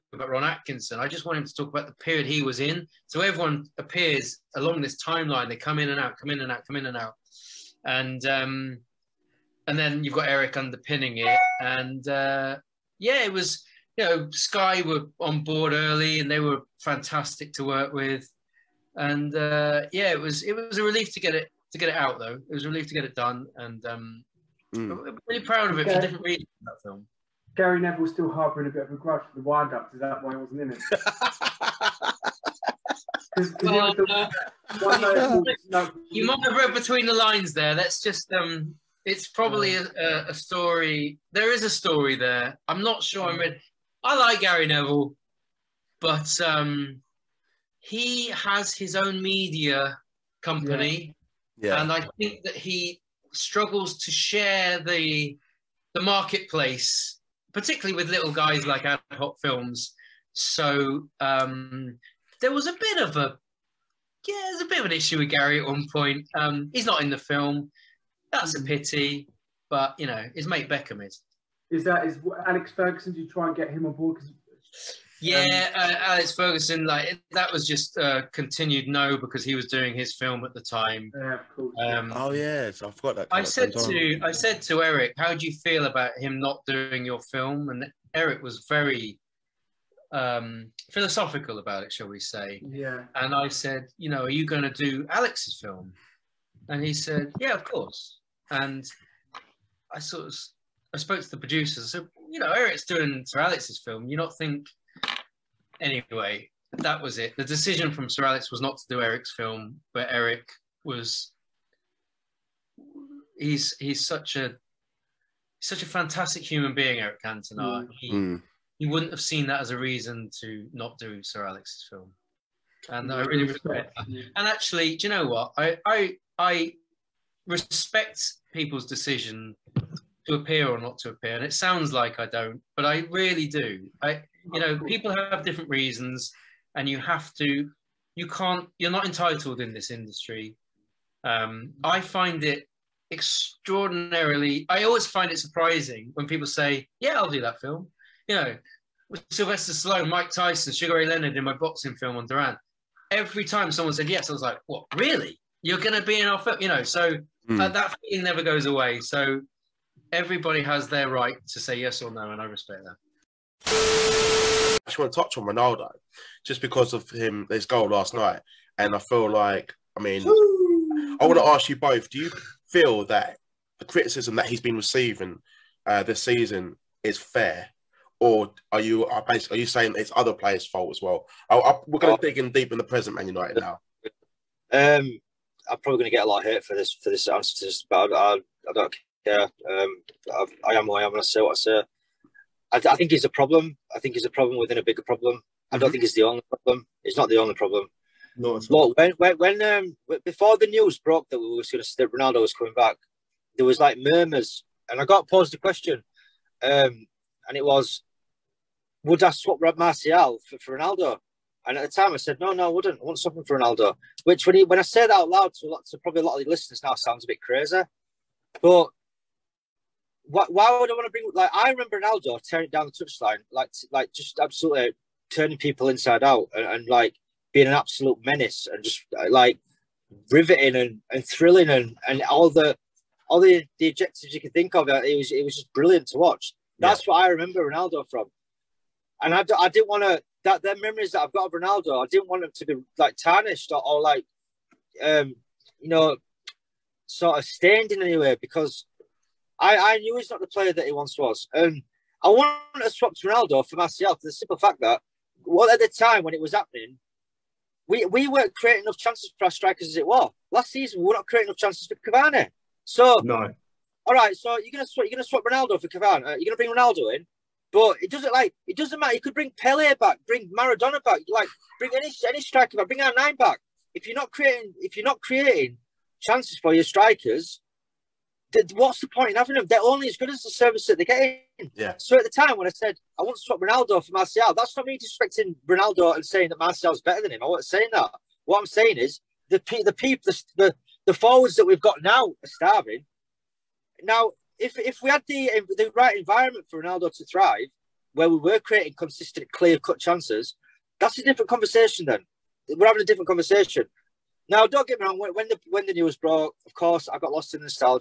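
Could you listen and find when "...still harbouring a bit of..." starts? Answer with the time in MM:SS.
00:28.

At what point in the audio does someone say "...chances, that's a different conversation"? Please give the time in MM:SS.
04:59.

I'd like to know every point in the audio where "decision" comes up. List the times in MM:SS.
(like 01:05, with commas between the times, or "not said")
01:47, 02:08.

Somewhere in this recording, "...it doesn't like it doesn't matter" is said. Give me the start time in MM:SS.
04:28.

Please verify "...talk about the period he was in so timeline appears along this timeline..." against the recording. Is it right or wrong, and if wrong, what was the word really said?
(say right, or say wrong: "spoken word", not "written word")
wrong: "everyone", not "timeline".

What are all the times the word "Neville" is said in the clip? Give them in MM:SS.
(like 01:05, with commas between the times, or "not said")
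00:27, 00:44.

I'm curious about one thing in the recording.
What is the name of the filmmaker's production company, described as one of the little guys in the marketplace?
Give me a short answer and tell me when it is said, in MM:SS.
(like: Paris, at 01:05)
ad hoc films, at 00:58.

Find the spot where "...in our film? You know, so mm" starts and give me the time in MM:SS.
02:36.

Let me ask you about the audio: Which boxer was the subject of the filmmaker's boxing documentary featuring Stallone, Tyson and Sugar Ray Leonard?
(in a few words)
Duran.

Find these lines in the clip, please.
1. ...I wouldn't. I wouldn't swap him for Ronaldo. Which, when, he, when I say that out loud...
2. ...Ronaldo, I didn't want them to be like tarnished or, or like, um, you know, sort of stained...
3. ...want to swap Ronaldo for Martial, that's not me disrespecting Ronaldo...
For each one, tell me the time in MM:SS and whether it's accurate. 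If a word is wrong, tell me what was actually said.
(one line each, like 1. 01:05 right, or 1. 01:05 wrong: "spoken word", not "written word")
1. 03:32 right
2. 04:01 right
3. 04:43 right.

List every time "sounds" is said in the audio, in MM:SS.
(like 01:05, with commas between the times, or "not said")
02:11, 03:36.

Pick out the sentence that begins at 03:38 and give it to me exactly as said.
But why, why would I want to bring?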